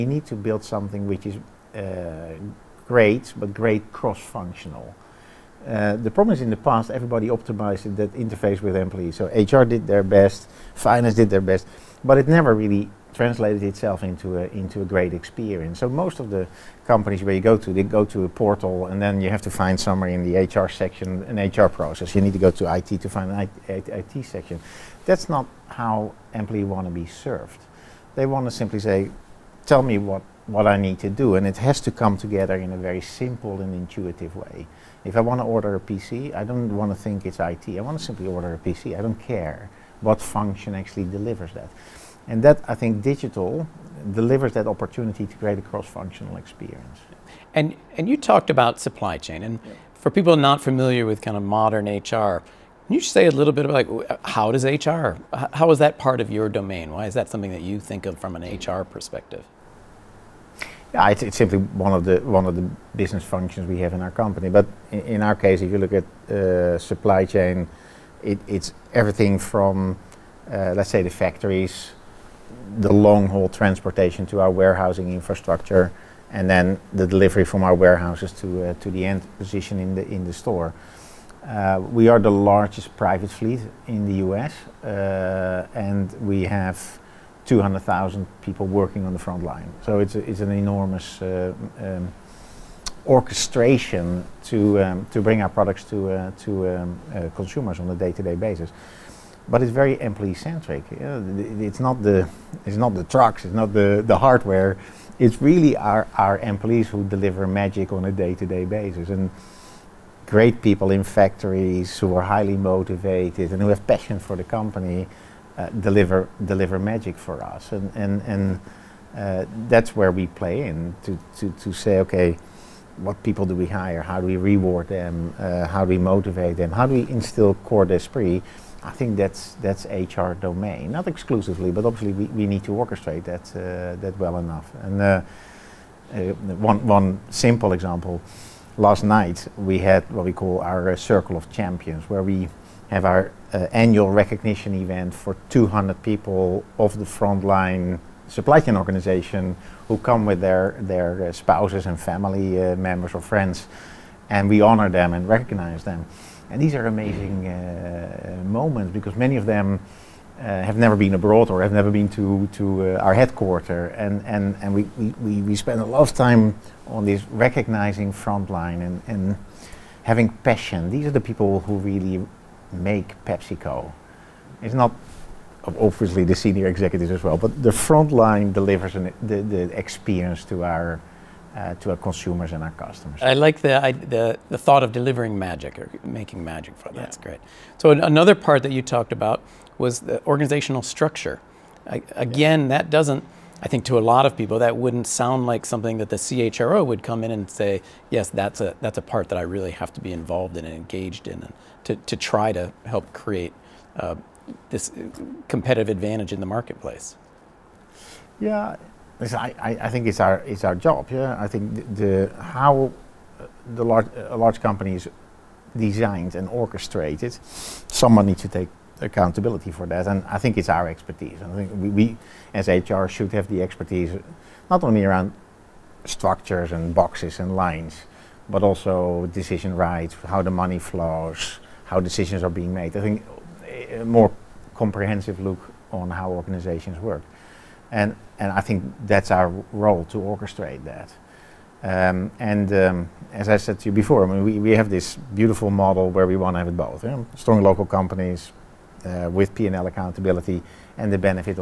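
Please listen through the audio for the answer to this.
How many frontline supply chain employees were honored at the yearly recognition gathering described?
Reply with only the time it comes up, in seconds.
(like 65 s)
145 s.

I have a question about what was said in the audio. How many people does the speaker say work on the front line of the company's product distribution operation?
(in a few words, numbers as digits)
200,000.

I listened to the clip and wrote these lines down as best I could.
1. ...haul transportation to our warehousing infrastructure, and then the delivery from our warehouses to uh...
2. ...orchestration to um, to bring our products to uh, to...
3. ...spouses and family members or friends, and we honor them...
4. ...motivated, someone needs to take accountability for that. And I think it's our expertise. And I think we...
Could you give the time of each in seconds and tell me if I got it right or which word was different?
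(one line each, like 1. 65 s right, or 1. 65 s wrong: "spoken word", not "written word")
1. 73 s right
2. 93 s right
3. 151 s right
4. 216 s wrong: "orchestrated", not "motivated".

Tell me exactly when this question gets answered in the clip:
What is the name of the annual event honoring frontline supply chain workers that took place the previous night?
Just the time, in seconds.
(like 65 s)
140 s.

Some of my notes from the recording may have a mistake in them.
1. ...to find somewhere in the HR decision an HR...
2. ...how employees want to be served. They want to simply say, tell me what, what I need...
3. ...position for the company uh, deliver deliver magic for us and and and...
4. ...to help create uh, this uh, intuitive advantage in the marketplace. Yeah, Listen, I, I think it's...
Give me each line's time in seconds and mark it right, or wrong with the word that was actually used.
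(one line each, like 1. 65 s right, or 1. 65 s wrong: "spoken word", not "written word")
1. 19 s wrong: "section", not "decision"
2. 25 s right
3. 113 s wrong: "passion", not "position"
4. 202 s wrong: "competitive", not "intuitive".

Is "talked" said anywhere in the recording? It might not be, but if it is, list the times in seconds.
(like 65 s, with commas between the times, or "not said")
48 s, 188 s.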